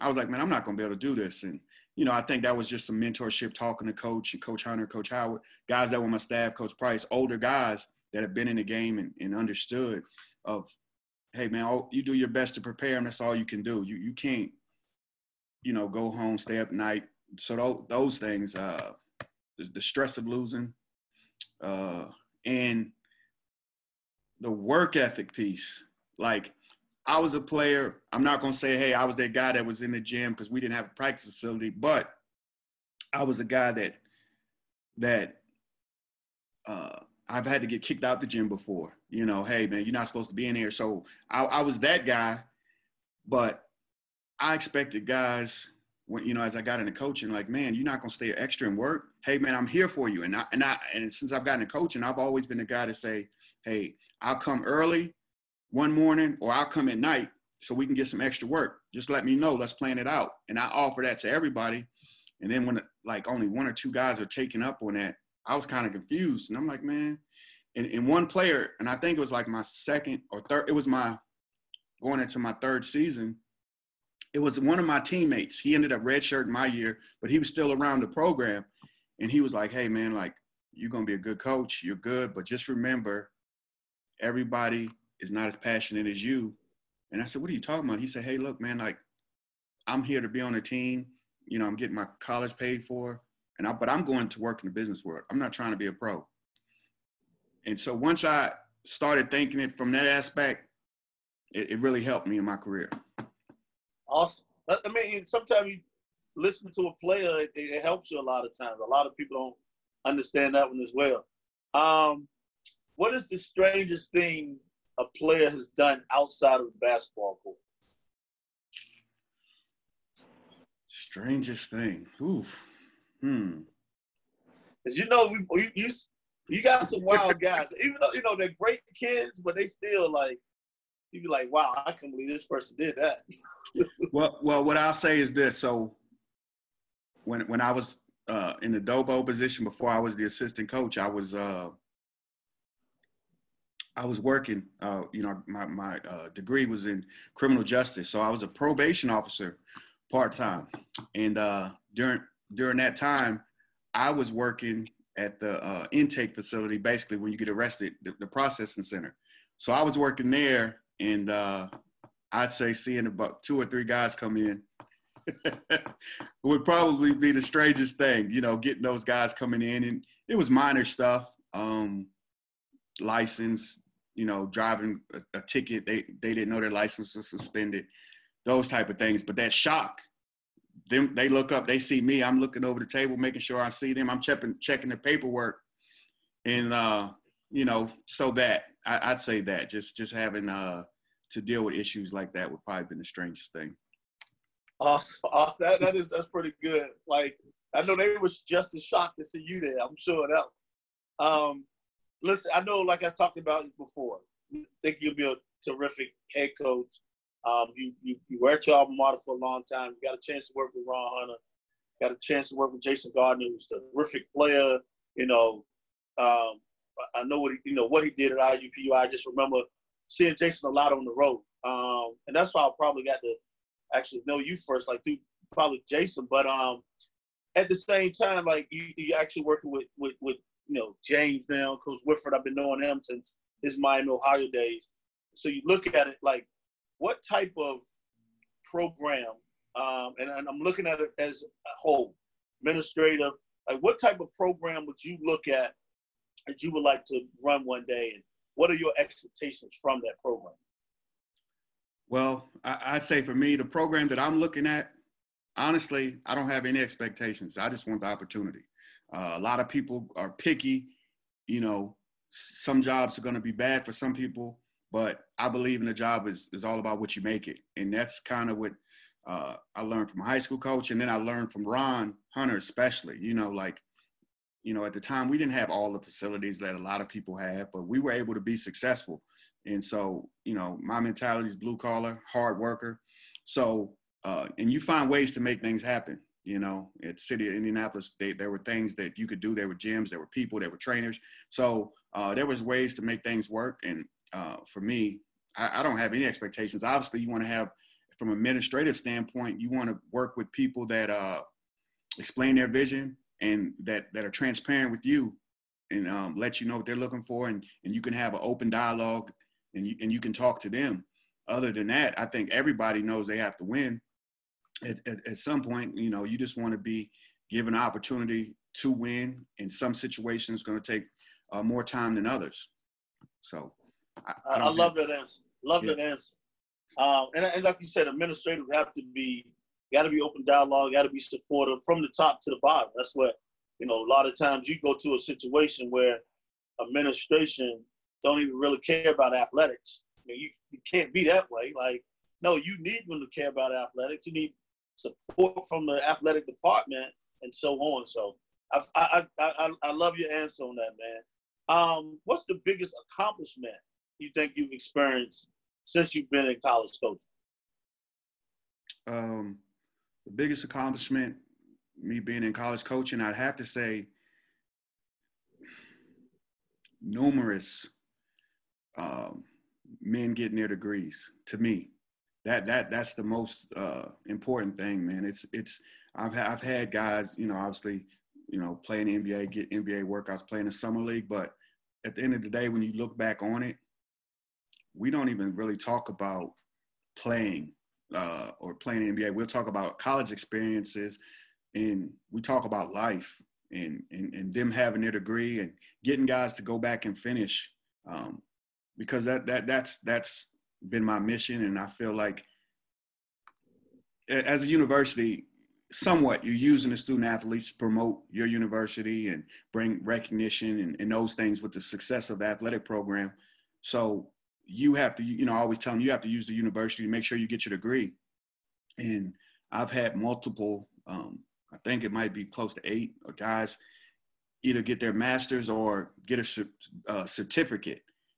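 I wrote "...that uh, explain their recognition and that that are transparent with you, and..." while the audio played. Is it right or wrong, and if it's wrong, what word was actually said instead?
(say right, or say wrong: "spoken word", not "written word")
wrong: "vision", not "recognition".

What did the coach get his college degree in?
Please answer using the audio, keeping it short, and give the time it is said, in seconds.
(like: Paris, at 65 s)
Criminal justice, at 147 s.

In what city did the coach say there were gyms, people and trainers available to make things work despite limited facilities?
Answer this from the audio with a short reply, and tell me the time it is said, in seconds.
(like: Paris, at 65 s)
Indianapolis, at 287 s.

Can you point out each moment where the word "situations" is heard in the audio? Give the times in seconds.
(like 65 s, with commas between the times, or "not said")
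319 s, 335 s.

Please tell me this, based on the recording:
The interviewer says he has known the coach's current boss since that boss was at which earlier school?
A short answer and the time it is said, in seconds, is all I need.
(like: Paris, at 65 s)
Miami, Ohio, at 233 s.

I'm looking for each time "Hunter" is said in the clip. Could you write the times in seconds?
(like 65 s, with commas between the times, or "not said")
4 s, 211 s, 272 s.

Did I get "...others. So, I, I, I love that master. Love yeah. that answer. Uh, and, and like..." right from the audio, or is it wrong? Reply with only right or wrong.
wrong.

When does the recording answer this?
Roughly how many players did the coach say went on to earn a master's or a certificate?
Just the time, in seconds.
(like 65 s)
422 s.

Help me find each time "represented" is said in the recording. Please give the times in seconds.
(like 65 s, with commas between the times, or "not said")
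not said.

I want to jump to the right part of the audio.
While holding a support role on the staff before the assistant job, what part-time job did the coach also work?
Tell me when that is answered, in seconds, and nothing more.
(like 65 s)
148 s.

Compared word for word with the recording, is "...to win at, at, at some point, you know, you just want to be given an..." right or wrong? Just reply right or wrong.
right.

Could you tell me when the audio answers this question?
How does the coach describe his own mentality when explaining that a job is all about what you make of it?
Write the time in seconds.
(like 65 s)
281 s.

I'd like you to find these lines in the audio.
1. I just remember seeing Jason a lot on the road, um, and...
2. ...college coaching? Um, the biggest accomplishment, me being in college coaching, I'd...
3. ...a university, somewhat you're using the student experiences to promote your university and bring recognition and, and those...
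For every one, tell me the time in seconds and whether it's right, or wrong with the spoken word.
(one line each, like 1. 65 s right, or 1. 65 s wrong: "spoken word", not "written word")
1. 218 s right
2. 356 s right
3. 404 s wrong: "athletes", not "experiences".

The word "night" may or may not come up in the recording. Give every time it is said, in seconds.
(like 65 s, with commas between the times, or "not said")
16 s, 56 s.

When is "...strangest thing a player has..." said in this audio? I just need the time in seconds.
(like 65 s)
113 s.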